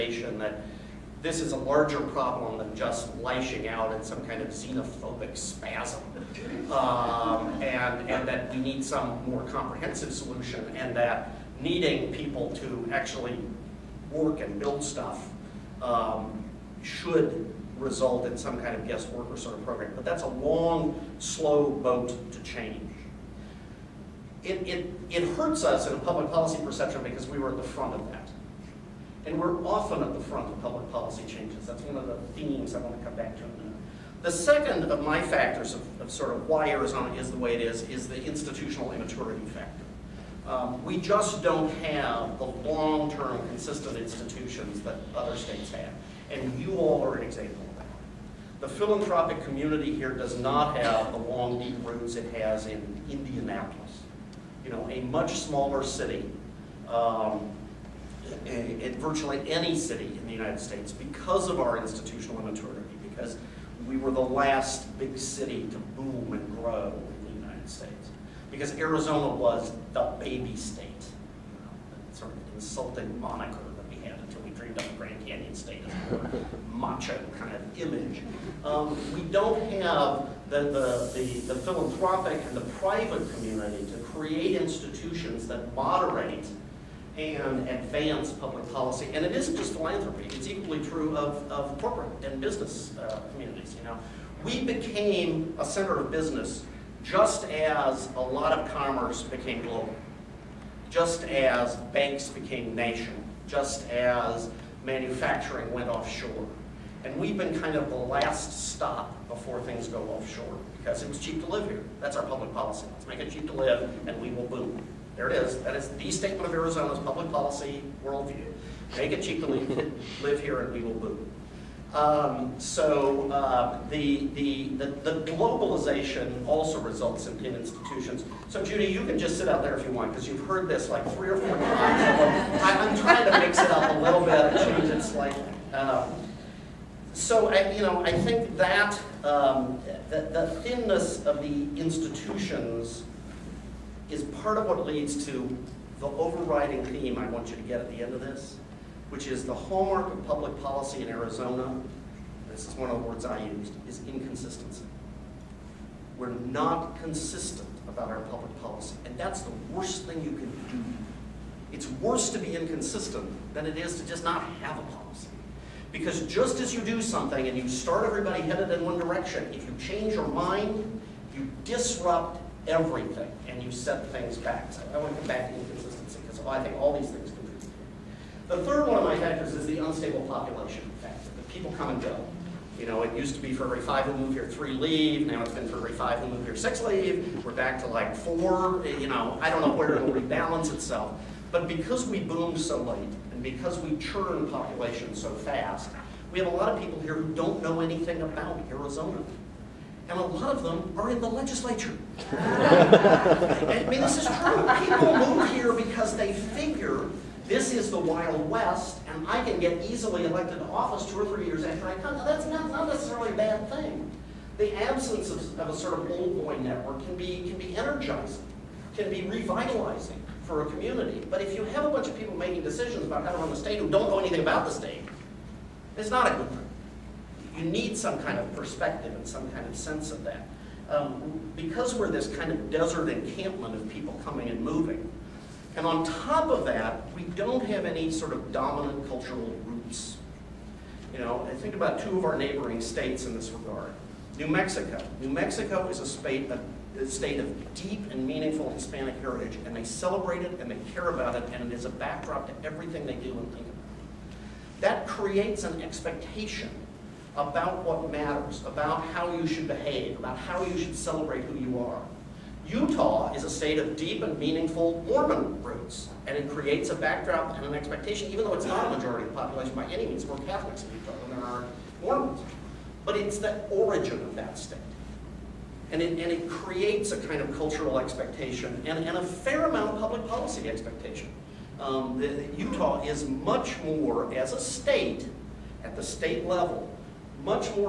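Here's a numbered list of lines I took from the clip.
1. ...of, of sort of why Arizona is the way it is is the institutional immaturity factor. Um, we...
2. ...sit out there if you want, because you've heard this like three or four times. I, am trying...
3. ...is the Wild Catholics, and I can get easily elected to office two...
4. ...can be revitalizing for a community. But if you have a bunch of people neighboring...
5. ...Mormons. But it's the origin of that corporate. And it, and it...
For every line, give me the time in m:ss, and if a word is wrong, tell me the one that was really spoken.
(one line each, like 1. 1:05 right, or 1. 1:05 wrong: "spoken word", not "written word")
1. 0:35 right
2. 2:09 right
3. 3:27 wrong: "West", not "Catholics"
4. 3:38 wrong: "making", not "neighboring"
5. 4:32 wrong: "state", not "corporate".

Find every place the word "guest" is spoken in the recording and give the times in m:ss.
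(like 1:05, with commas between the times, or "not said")
0:18.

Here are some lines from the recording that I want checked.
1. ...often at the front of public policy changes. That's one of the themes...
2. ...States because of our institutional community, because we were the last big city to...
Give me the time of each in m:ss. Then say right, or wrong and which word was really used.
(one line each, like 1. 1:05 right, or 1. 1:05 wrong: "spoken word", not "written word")
1. 0:29 right
2. 1:00 wrong: "immaturity", not "community".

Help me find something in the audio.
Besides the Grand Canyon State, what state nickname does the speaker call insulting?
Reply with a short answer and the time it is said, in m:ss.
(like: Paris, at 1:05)
the baby state, at 1:09.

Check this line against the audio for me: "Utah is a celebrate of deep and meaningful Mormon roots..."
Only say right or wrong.
wrong.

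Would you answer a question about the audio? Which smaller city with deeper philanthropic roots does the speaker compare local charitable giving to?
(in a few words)
Indianapolis.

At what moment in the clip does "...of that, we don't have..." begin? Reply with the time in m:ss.
3:56.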